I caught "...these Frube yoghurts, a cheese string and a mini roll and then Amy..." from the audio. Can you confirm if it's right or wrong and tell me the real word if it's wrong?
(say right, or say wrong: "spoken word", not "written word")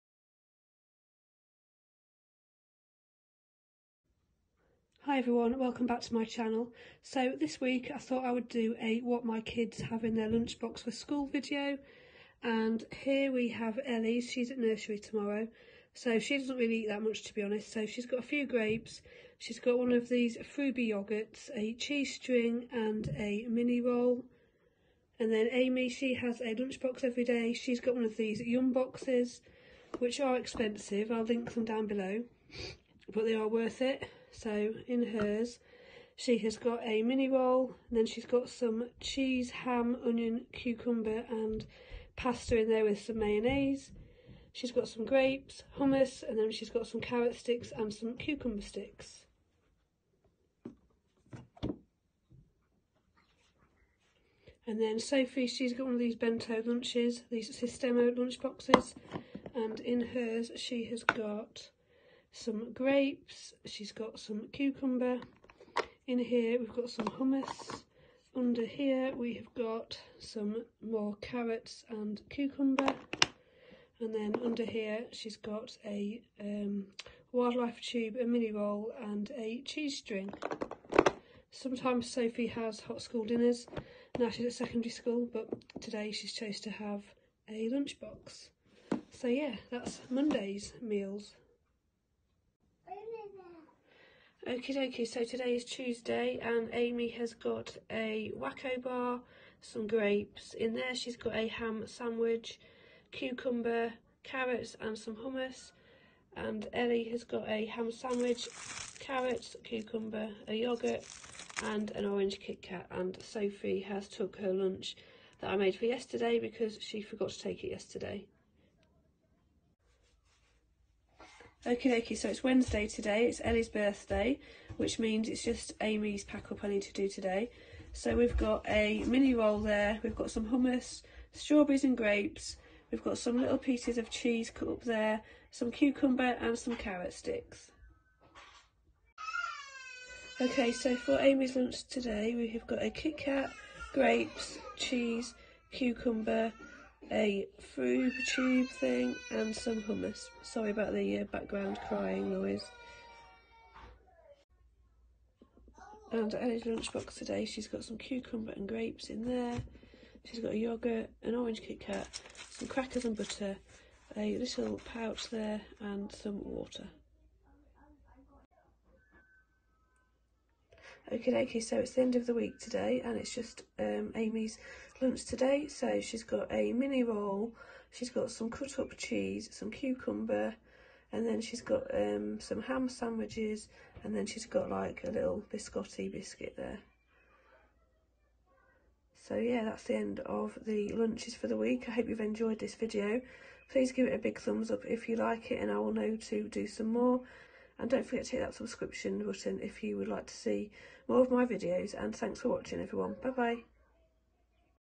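right.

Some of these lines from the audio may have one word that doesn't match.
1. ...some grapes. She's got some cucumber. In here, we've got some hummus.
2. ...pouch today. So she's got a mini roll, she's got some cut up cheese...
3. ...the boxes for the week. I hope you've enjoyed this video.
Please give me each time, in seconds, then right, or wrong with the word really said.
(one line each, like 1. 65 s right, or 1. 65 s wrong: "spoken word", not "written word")
1. 62 s right
2. 175 s wrong: "lunch", not "pouch"
3. 190 s wrong: "lunches", not "boxes".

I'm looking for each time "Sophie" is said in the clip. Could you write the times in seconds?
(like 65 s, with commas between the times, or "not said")
54 s, 82 s, 113 s.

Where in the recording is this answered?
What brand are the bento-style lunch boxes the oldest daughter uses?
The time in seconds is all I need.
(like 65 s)
57 s.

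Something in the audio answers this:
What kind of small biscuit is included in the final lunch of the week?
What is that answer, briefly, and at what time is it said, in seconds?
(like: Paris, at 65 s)
biscotti, at 185 s.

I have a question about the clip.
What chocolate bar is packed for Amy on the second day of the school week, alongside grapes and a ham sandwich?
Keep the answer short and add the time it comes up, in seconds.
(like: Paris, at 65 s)
Wacko bar, at 98 s.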